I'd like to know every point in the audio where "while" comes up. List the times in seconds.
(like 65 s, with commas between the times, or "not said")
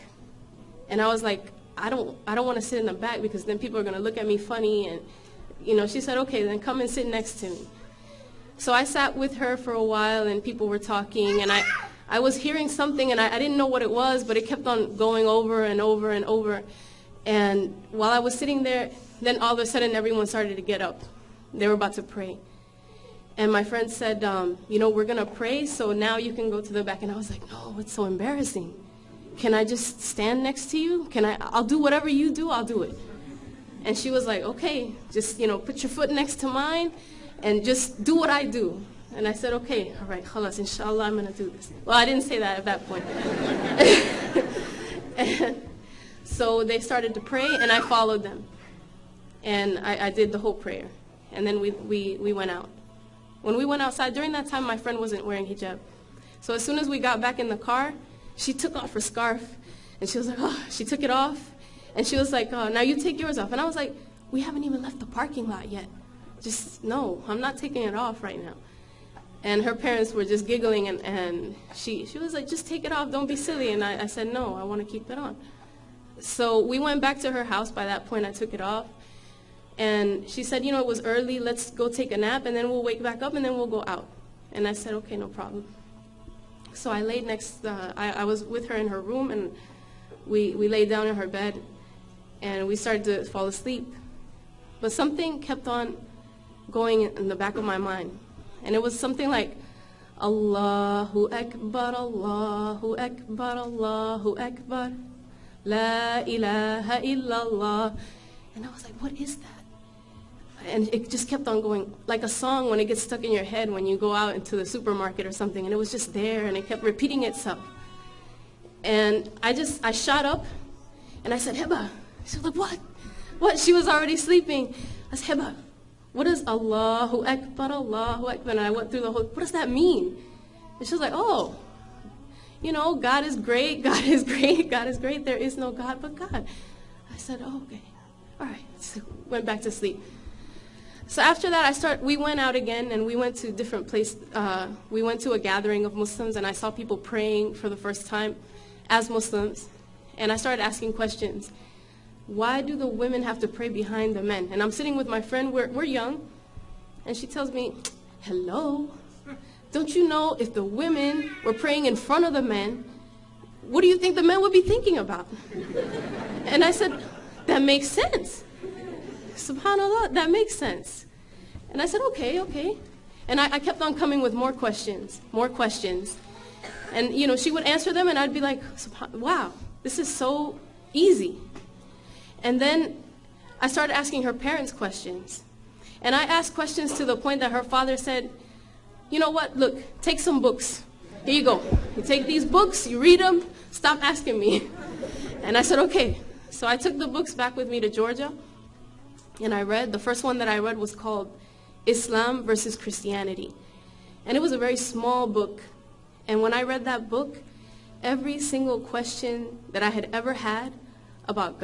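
9 s, 17 s.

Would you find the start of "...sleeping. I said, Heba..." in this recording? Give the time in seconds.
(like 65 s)
124 s.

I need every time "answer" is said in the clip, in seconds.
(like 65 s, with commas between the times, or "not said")
177 s.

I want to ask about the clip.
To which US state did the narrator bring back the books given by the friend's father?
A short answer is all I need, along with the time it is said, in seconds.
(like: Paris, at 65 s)
Georgia, at 197 s.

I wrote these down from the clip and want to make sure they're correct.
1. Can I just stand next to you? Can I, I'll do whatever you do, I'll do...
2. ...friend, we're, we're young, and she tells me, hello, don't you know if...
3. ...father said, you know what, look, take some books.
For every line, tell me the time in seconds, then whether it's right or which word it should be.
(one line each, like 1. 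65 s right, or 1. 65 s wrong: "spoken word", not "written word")
1. 29 s right
2. 155 s right
3. 187 s right.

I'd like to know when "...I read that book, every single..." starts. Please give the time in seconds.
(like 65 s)
206 s.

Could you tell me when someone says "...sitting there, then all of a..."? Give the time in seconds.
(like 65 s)
18 s.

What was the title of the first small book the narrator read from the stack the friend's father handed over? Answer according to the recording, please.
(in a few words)
Islam versus Christianity.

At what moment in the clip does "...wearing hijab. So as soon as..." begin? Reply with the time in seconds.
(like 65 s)
55 s.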